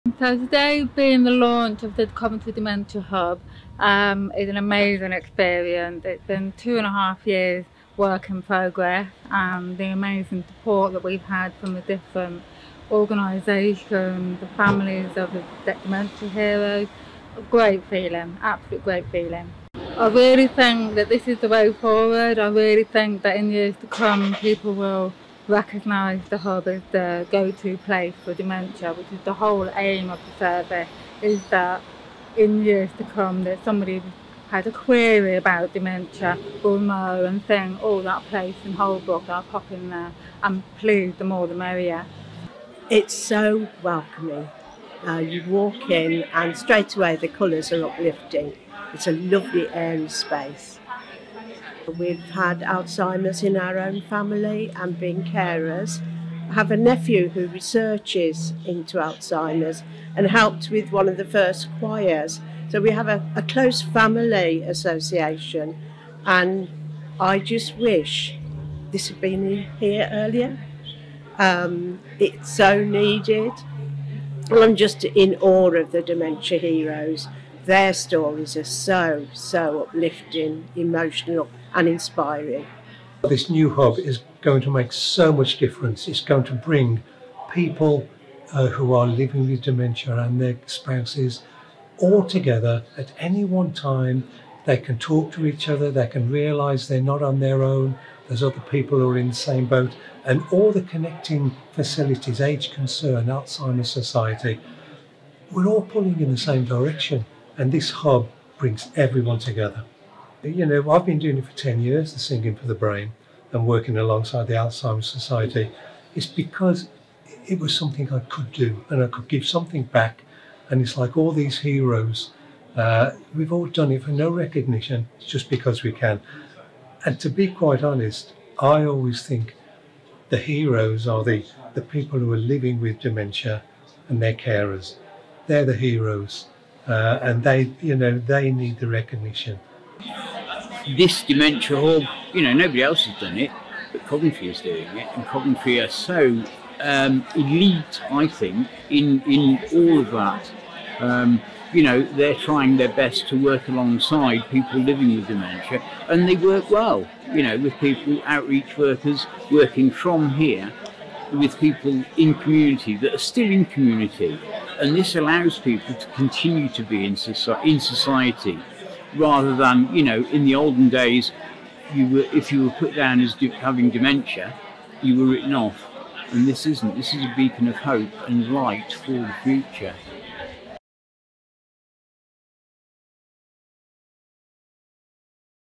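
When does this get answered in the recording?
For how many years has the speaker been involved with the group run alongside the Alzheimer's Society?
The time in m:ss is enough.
1:51.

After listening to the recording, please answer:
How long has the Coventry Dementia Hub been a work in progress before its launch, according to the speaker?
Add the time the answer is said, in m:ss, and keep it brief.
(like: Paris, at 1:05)
2.5 years, at 0:06.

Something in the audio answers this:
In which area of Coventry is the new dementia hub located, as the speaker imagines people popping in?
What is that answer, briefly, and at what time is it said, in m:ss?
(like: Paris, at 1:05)
Holbrook, at 0:38.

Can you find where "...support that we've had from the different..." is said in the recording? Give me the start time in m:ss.
0:10.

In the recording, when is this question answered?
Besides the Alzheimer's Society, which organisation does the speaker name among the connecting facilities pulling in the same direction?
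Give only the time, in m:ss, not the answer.
1:42.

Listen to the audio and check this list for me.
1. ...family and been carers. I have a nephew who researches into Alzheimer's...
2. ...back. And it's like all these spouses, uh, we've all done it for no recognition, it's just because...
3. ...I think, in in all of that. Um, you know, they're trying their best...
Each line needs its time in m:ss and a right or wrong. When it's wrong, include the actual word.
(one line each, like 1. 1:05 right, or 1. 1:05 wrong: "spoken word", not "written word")
1. 0:54 right
2. 1:59 wrong: "heroes", not "spouses"
3. 2:28 right.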